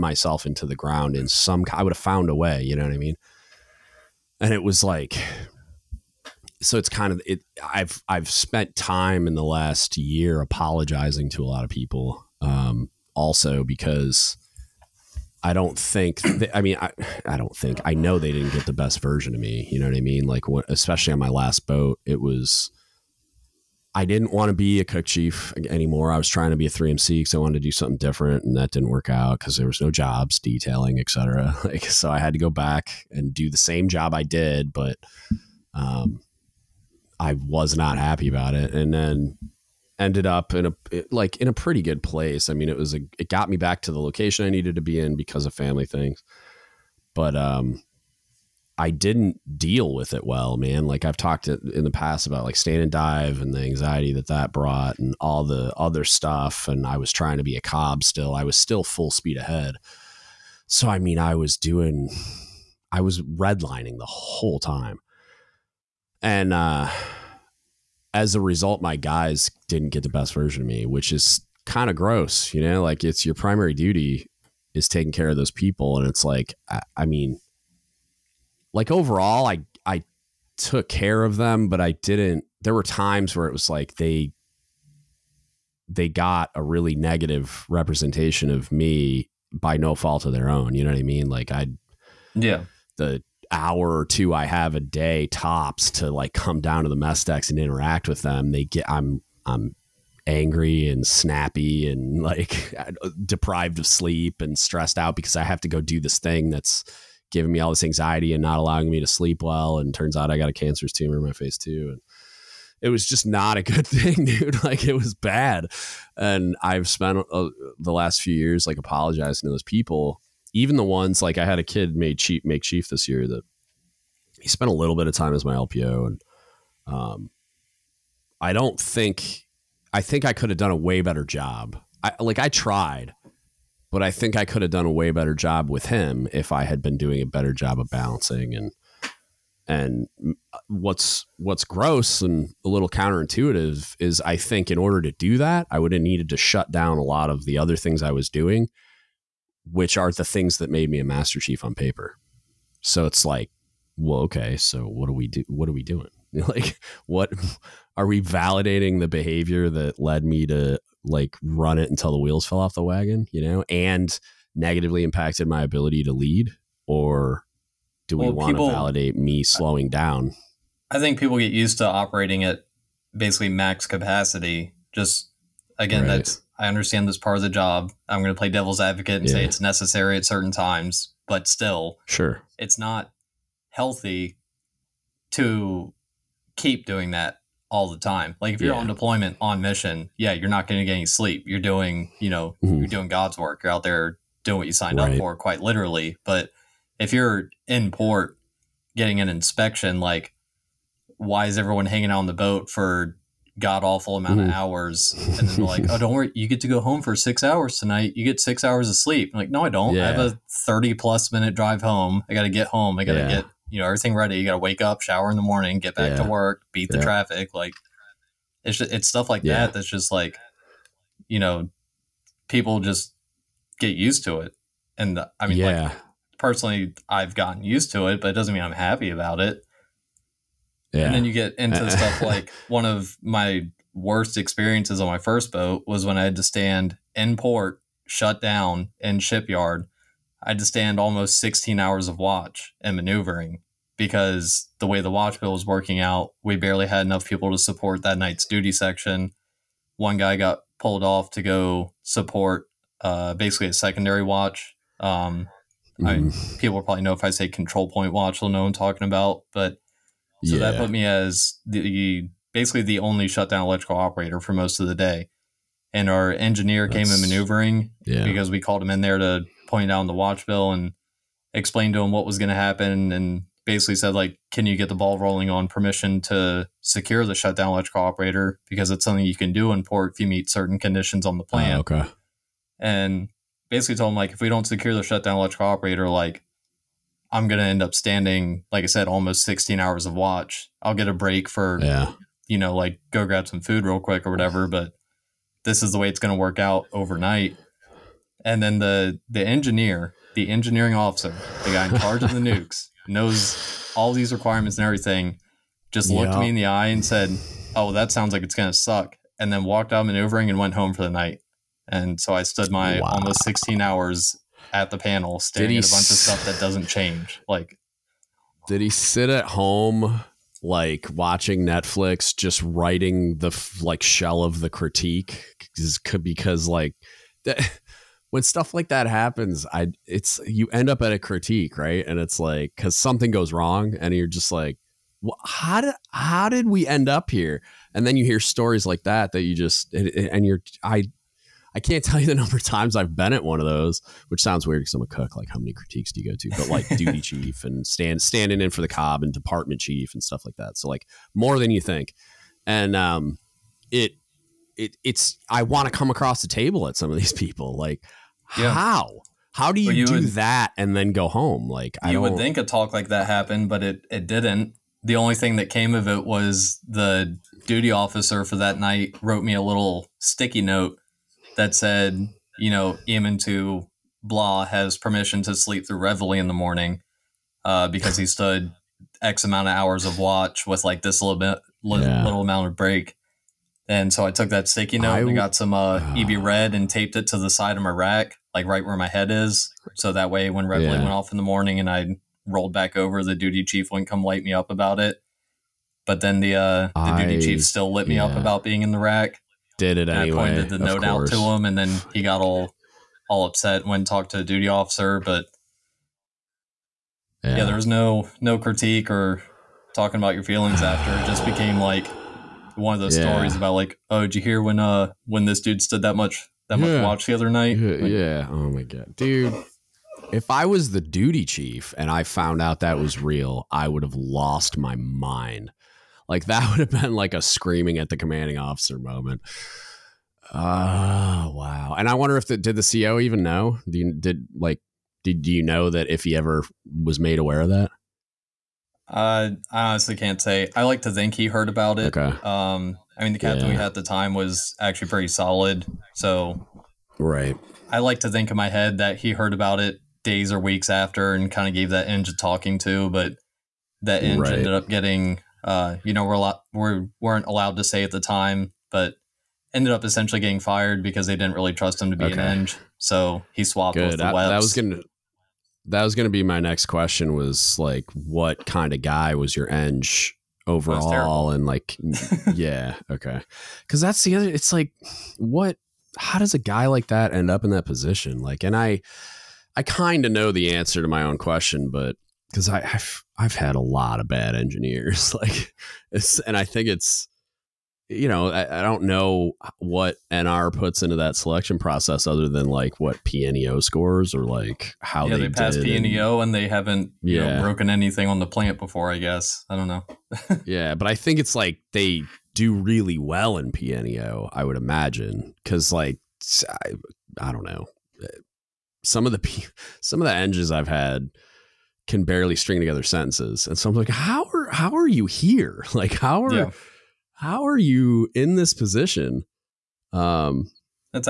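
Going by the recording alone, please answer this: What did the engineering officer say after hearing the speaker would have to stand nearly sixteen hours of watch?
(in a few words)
That sounds like it's going to suck.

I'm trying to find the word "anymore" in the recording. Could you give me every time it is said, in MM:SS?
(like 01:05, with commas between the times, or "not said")
00:25.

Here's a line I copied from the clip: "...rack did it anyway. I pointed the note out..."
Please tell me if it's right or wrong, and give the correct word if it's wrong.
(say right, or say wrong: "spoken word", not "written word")
right.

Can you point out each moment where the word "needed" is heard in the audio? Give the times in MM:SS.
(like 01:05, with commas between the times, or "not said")
00:44, 02:26.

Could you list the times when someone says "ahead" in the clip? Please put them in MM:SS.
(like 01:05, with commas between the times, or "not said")
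00:59.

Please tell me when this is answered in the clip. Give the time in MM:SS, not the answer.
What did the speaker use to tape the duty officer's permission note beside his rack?
06:26.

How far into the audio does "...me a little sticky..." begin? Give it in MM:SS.
06:09.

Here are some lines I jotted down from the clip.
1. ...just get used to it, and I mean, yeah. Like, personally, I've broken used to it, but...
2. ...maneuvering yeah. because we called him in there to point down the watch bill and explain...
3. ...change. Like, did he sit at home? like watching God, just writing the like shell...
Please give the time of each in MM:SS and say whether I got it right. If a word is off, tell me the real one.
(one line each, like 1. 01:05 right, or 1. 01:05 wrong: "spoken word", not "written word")
1. 03:42 wrong: "gotten", not "broken"
2. 04:27 right
3. 05:16 wrong: "Netflix", not "God".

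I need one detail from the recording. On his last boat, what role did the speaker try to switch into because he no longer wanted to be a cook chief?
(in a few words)
3MC.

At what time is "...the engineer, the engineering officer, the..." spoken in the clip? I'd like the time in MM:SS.
04:59.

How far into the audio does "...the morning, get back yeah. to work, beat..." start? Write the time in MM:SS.
03:35.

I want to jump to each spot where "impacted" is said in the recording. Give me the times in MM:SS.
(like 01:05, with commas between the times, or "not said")
02:45.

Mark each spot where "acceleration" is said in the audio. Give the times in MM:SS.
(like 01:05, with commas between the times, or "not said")
not said.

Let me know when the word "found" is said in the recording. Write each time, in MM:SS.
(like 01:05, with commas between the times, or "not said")
00:01, 07:02.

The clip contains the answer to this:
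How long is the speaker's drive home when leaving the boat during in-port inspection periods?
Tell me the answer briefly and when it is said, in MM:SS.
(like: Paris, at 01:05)
30 plus minutes, at 03:30.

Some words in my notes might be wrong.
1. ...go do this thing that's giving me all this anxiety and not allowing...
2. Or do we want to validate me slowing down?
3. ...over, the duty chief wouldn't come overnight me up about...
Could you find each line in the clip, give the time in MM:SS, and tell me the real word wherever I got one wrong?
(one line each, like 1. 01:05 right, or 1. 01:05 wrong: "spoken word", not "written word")
1. 01:45 right
2. 02:46 right
3. 06:32 wrong: "light", not "overnight".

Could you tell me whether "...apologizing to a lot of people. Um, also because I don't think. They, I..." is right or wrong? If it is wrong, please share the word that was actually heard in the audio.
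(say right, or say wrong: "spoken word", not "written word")
right.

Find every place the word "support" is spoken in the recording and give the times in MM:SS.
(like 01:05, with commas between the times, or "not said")
04:07, 04:12.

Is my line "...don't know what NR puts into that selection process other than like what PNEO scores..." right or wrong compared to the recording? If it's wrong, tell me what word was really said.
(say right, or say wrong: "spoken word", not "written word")
right.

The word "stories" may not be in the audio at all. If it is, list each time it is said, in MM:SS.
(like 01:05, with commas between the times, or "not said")
05:38, 06:53.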